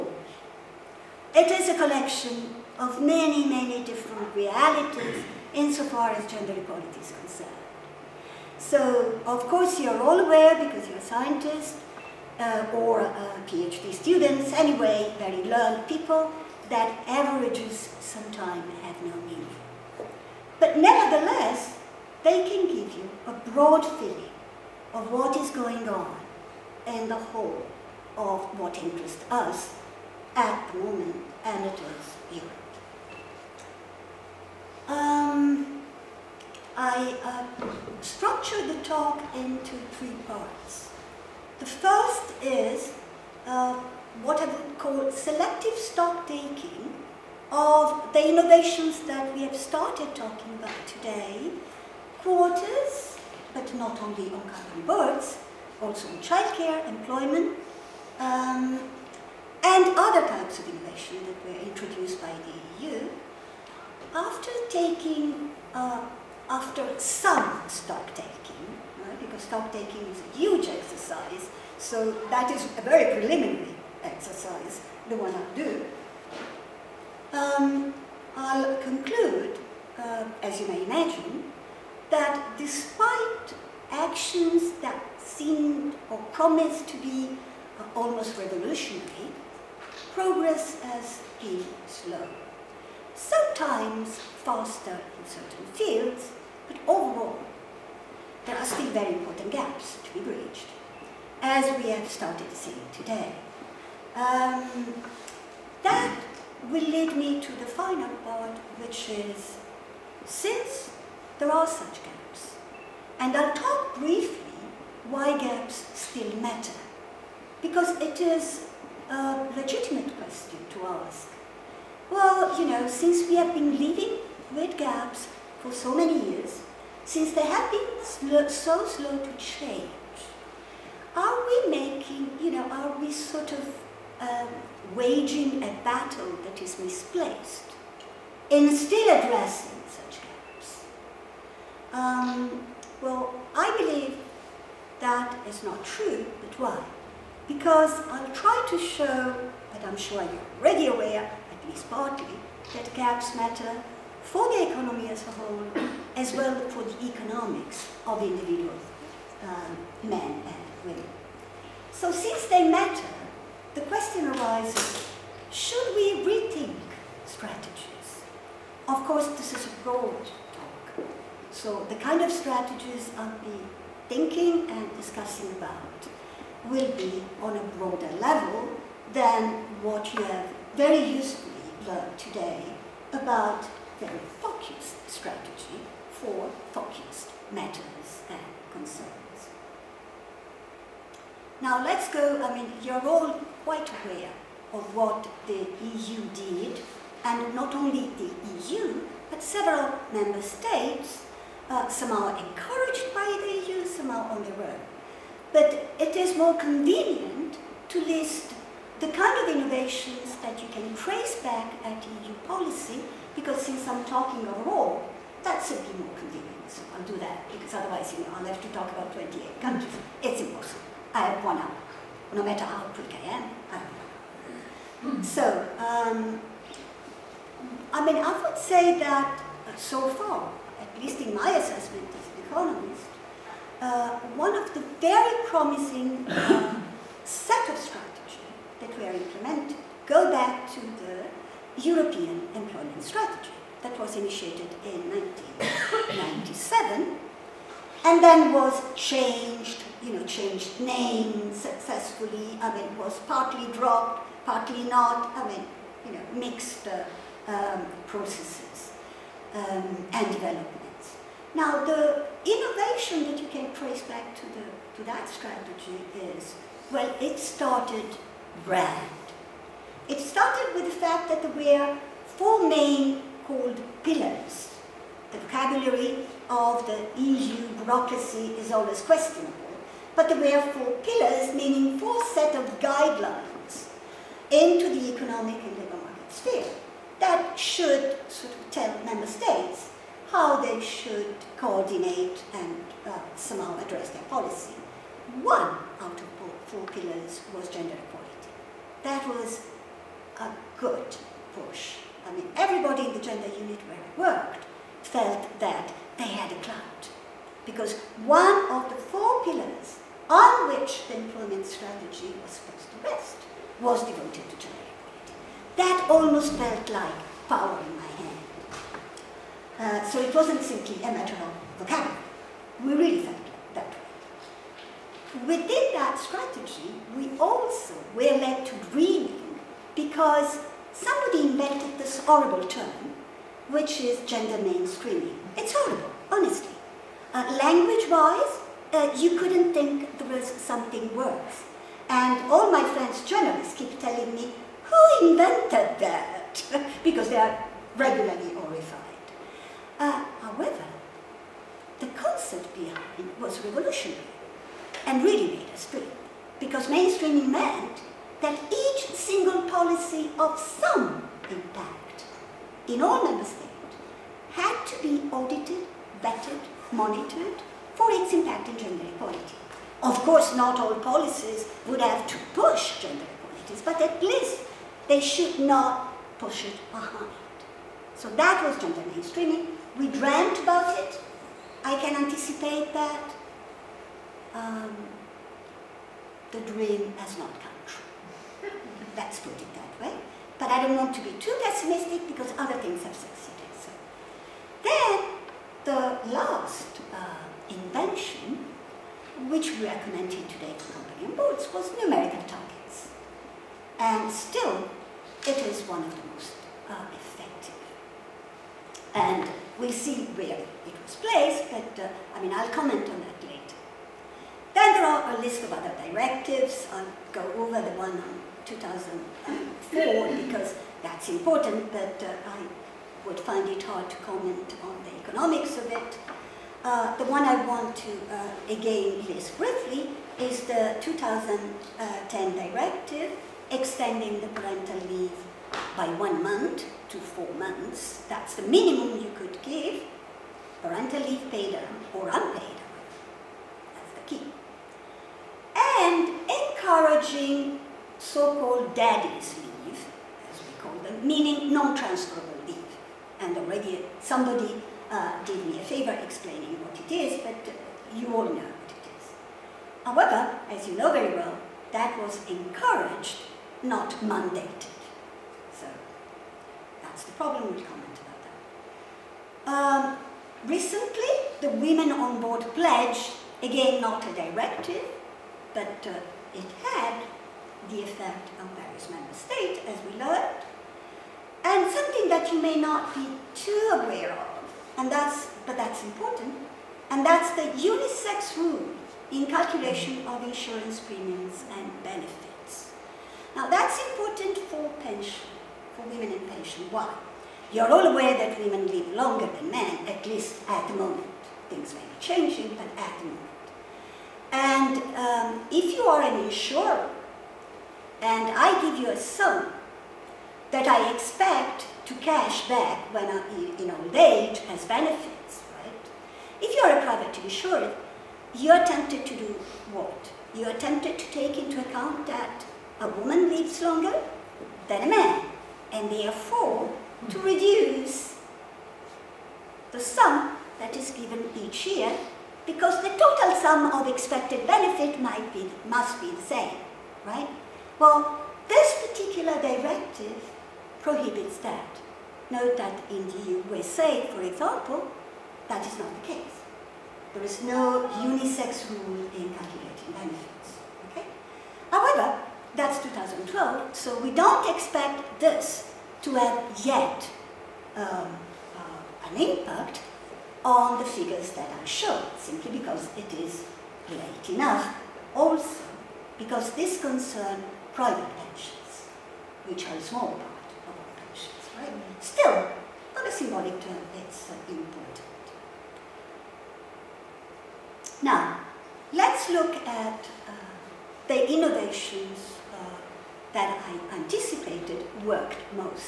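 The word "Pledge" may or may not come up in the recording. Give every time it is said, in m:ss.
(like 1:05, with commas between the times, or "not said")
7:52.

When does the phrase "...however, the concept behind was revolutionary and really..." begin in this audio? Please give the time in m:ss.
5:50.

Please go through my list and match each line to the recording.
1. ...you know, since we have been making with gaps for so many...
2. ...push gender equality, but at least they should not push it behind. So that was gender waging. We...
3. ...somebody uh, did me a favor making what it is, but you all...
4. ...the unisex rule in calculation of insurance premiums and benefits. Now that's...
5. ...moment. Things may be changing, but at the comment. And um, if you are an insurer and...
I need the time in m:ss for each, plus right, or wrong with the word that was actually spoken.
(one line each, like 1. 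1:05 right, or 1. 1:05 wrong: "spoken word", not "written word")
1. 2:02 wrong: "living", not "making"
2. 6:12 wrong: "mainstreaming", not "waging"
3. 7:34 wrong: "explaining", not "making"
4. 8:07 right
5. 8:20 wrong: "moment", not "comment".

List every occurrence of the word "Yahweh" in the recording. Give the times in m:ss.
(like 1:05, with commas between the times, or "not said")
not said.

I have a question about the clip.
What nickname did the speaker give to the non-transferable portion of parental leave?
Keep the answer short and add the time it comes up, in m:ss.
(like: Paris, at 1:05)
daddy's leave, at 7:28.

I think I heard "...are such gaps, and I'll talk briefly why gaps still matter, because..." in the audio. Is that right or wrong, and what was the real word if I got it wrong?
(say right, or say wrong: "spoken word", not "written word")
right.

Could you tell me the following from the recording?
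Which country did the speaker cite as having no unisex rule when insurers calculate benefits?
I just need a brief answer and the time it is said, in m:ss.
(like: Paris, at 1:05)
USA, at 9:03.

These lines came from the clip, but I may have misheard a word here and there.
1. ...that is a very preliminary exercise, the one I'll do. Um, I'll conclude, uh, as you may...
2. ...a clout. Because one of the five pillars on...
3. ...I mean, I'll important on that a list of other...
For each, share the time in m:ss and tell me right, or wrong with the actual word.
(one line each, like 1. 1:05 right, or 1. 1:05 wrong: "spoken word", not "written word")
1. 1:12 right
2. 5:06 wrong: "four", not "five"
3. 6:52 wrong: "comment", not "important".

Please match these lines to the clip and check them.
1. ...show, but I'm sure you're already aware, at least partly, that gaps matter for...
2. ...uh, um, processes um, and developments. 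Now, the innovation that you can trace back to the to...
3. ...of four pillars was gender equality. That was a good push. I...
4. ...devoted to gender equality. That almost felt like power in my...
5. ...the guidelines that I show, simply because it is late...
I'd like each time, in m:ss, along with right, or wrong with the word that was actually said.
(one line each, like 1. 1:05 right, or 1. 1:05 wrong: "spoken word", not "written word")
1. 2:28 right
2. 4:16 right
3. 4:56 right
4. 5:14 right
5. 9:20 wrong: "figures", not "guidelines".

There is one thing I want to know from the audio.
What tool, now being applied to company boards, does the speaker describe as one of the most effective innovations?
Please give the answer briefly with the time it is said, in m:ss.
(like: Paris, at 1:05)
numerical targets, at 6:42.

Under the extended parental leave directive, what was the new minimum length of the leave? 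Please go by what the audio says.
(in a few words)
4 months.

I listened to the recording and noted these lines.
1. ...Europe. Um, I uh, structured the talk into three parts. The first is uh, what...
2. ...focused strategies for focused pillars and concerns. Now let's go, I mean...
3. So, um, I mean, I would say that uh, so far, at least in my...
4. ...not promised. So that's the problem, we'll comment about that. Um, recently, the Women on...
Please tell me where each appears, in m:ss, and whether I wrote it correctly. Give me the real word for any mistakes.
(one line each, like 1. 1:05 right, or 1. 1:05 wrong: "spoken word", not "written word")
1. 0:32 right
2. 3:04 wrong: "matters", not "pillars"
3. 3:45 right
4. 7:43 wrong: "mandated", not "promised".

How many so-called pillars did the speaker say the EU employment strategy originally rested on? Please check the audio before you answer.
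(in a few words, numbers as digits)
4.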